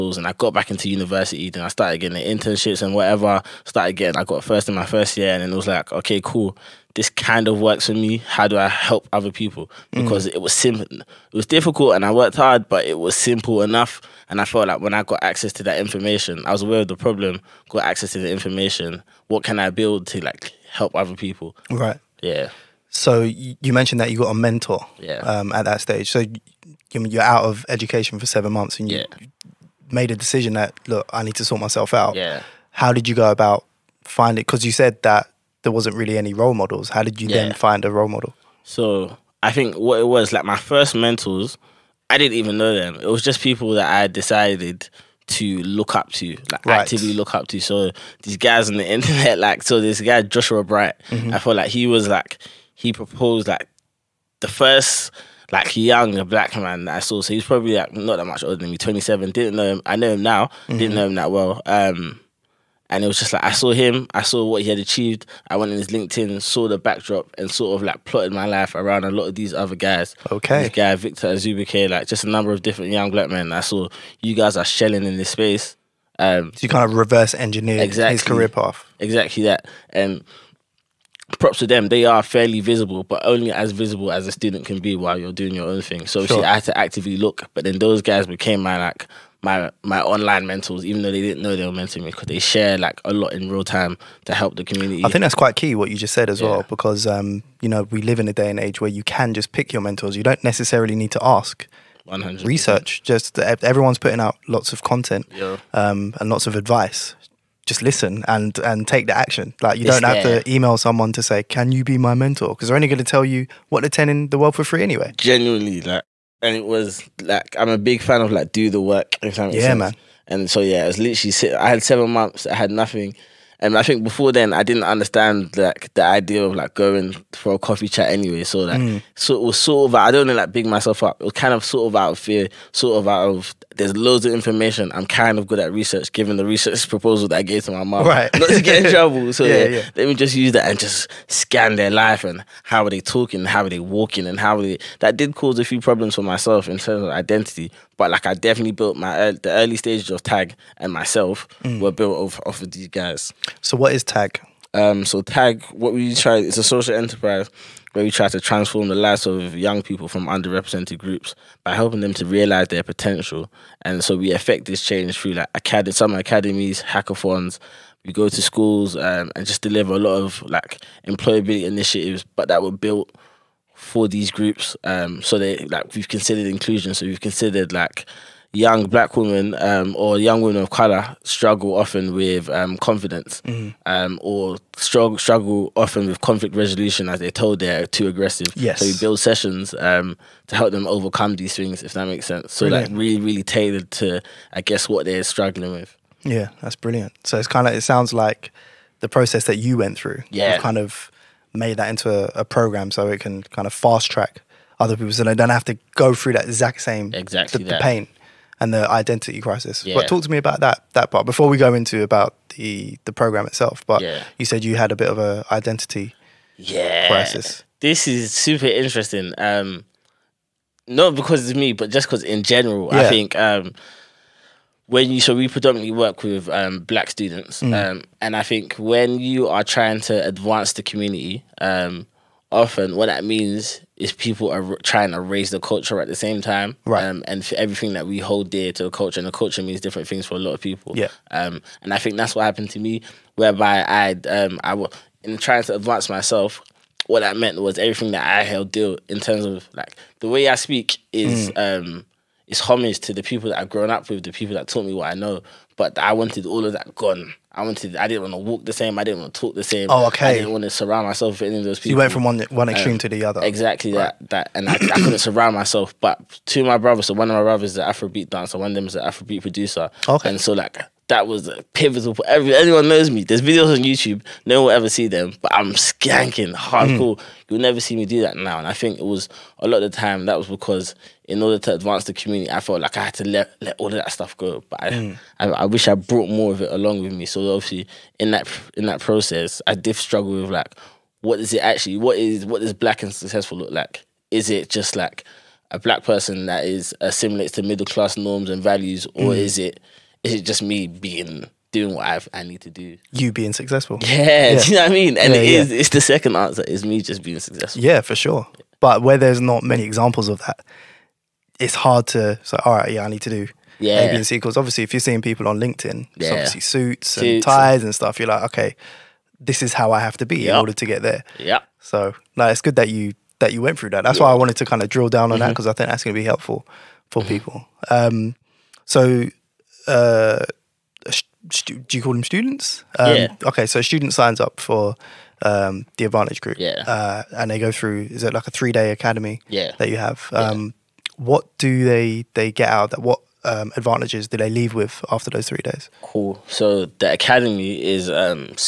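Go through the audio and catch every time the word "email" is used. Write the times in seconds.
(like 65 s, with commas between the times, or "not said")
110 s.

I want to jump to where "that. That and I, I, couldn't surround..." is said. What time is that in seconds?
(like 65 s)
264 s.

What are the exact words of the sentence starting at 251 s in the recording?
um is homage to the people that I've grown up with, the people that taught me what I know.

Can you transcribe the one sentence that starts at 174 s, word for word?
Um, so they like we've considered inclusion.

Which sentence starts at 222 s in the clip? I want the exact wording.
I think um, when you so we predominantly work with um, black students, mm.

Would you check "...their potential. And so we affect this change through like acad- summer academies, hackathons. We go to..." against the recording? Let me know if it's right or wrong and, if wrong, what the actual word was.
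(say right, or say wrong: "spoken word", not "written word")
right.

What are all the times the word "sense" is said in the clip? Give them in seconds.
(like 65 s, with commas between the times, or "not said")
119 s, 192 s.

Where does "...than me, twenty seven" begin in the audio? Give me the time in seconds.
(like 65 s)
58 s.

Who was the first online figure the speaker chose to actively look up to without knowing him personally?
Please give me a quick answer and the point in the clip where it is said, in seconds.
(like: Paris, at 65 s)
Joshua Bright, at 50 s.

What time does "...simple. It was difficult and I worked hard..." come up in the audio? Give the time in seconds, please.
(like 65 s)
10 s.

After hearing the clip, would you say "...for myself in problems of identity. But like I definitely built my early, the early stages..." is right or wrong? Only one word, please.
wrong.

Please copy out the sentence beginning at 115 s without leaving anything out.
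Genuinely, like, and it was like I'm a big fan of like do the work.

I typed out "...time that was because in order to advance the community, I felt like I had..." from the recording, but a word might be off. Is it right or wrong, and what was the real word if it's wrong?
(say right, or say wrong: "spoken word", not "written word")
right.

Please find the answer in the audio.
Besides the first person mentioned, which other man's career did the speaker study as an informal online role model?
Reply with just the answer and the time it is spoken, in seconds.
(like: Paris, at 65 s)
Victor Azubike, at 70 s.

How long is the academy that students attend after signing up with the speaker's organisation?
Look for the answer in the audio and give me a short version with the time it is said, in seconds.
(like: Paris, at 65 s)
3 days, at 338 s.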